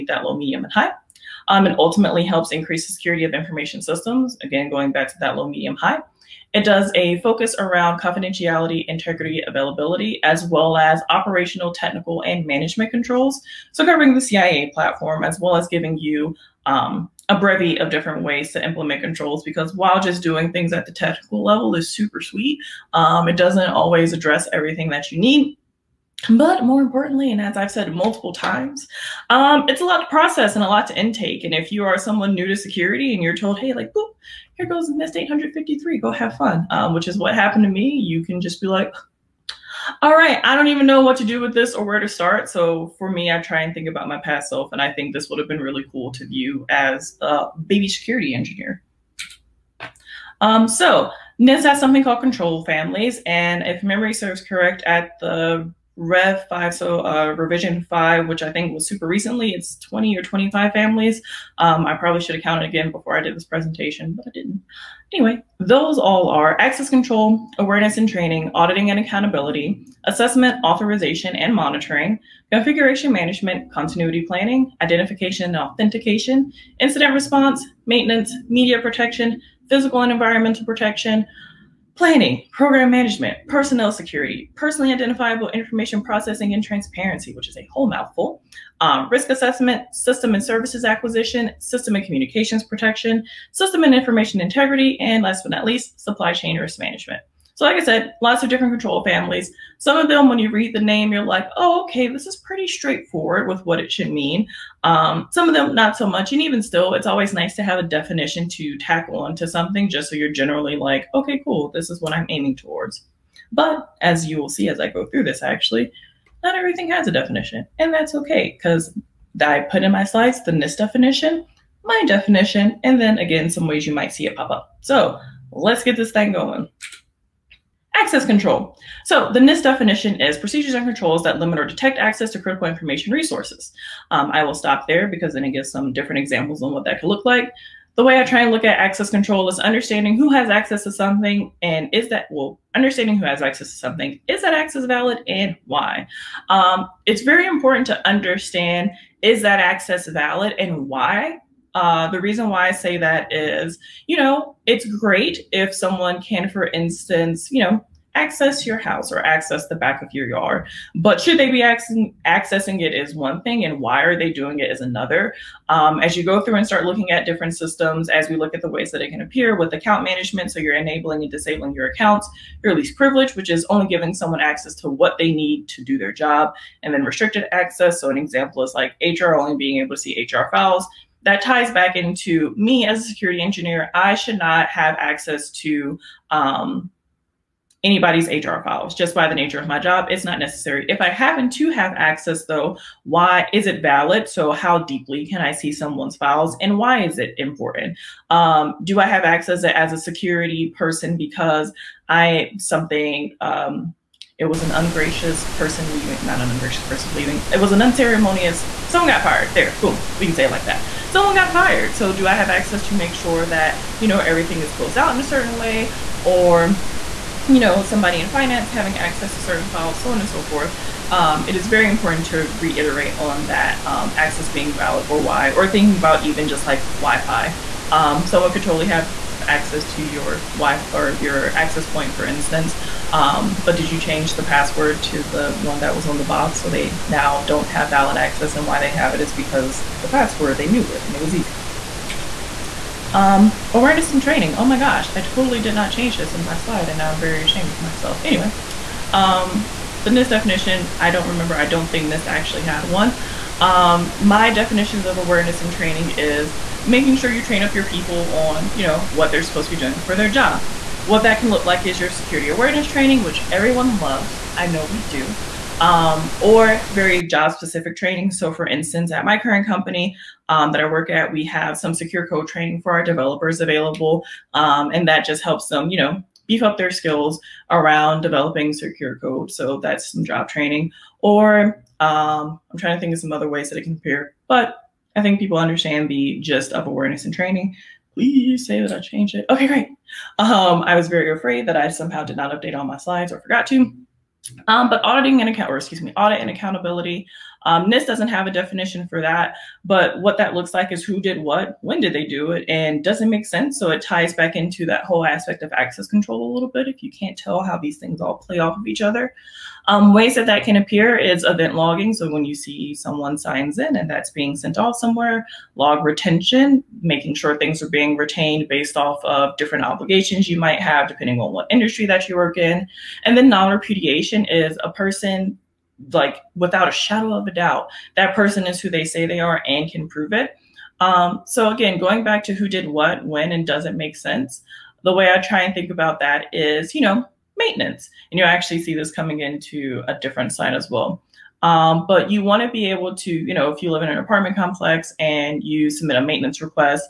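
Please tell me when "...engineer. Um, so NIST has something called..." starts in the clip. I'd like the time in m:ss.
0:48.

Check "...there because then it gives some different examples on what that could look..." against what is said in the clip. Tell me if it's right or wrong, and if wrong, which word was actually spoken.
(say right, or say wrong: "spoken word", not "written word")
right.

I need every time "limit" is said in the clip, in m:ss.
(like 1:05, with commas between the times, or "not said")
2:11.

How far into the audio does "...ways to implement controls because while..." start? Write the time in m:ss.
0:18.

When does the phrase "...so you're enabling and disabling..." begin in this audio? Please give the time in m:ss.
2:50.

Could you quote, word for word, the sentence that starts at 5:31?
Um, so again, going back to who did what, when, and does it make sense?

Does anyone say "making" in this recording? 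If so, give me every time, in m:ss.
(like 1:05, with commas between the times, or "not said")
4:16, 5:17.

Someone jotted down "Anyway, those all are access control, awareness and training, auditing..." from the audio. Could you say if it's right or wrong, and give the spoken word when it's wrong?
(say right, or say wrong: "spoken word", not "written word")
right.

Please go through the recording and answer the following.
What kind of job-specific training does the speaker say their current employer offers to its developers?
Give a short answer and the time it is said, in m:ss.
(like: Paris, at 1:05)
secure code training, at 4:31.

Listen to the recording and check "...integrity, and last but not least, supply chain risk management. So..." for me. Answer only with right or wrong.
right.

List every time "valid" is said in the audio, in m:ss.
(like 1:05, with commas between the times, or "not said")
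2:24, 2:30, 3:13, 3:44, 3:57.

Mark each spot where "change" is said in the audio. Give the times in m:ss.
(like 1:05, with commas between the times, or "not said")
3:54, 4:05, 4:48.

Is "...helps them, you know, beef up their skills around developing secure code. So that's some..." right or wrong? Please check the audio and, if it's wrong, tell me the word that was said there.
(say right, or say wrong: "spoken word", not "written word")
right.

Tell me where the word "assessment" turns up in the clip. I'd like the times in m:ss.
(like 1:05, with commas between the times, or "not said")
1:10, 1:29.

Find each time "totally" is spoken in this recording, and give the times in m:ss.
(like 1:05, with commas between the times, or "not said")
3:48, 4:05.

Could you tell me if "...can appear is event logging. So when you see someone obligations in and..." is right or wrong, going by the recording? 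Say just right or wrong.
wrong.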